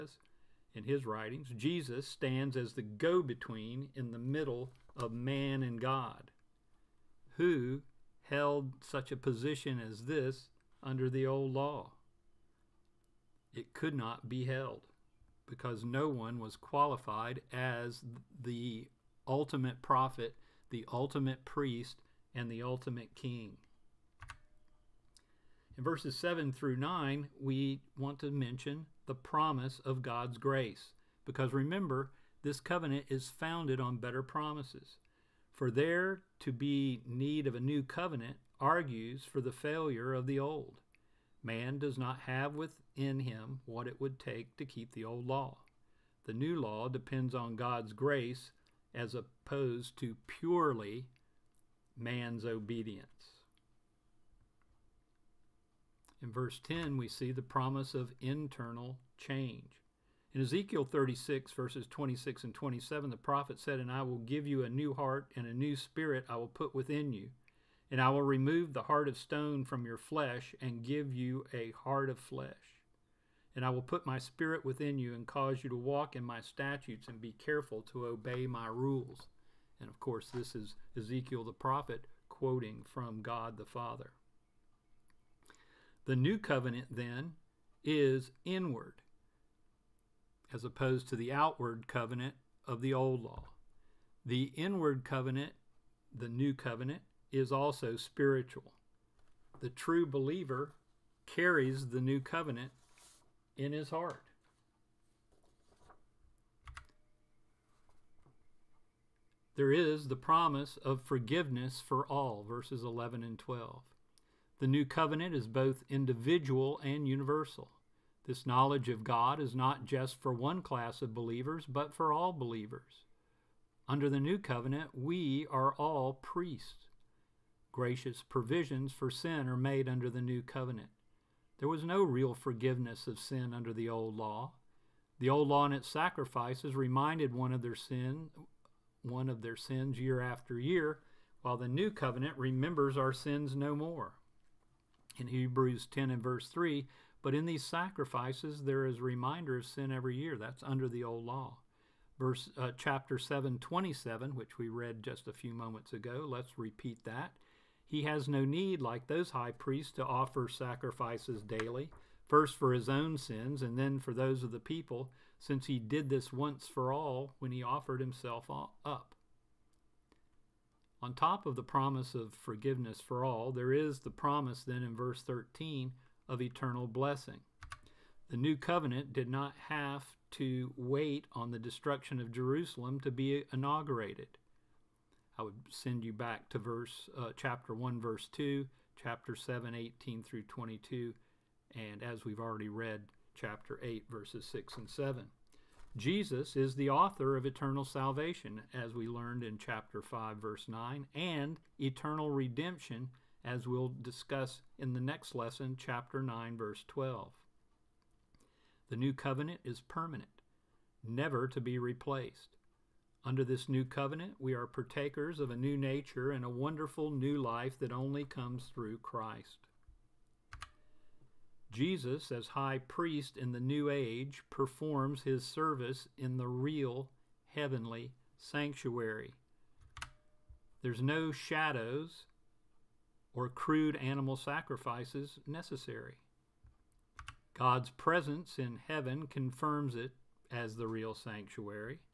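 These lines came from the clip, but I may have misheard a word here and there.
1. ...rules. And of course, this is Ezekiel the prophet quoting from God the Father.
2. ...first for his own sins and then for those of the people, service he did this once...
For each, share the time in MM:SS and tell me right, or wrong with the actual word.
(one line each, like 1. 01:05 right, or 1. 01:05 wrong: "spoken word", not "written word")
1. 01:18 right
2. 02:42 wrong: "since", not "service".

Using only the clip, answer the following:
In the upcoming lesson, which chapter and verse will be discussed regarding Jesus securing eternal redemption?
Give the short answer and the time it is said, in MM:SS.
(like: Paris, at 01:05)
Chapter 9 verse 12, at 03:25.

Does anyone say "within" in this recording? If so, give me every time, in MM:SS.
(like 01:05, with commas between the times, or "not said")
00:42, 01:06, 01:14.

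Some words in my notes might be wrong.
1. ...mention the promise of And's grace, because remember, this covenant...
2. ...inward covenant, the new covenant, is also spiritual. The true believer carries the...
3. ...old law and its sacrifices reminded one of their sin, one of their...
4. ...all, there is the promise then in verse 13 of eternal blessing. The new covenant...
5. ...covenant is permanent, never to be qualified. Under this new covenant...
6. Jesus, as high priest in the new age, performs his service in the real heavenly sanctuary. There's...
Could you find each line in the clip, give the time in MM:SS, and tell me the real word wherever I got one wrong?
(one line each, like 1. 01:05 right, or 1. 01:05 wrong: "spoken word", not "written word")
1. 00:28 wrong: "God", not "And"
2. 01:34 right
3. 02:15 right
4. 02:53 right
5. 03:29 wrong: "replaced", not "qualified"
6. 03:41 right.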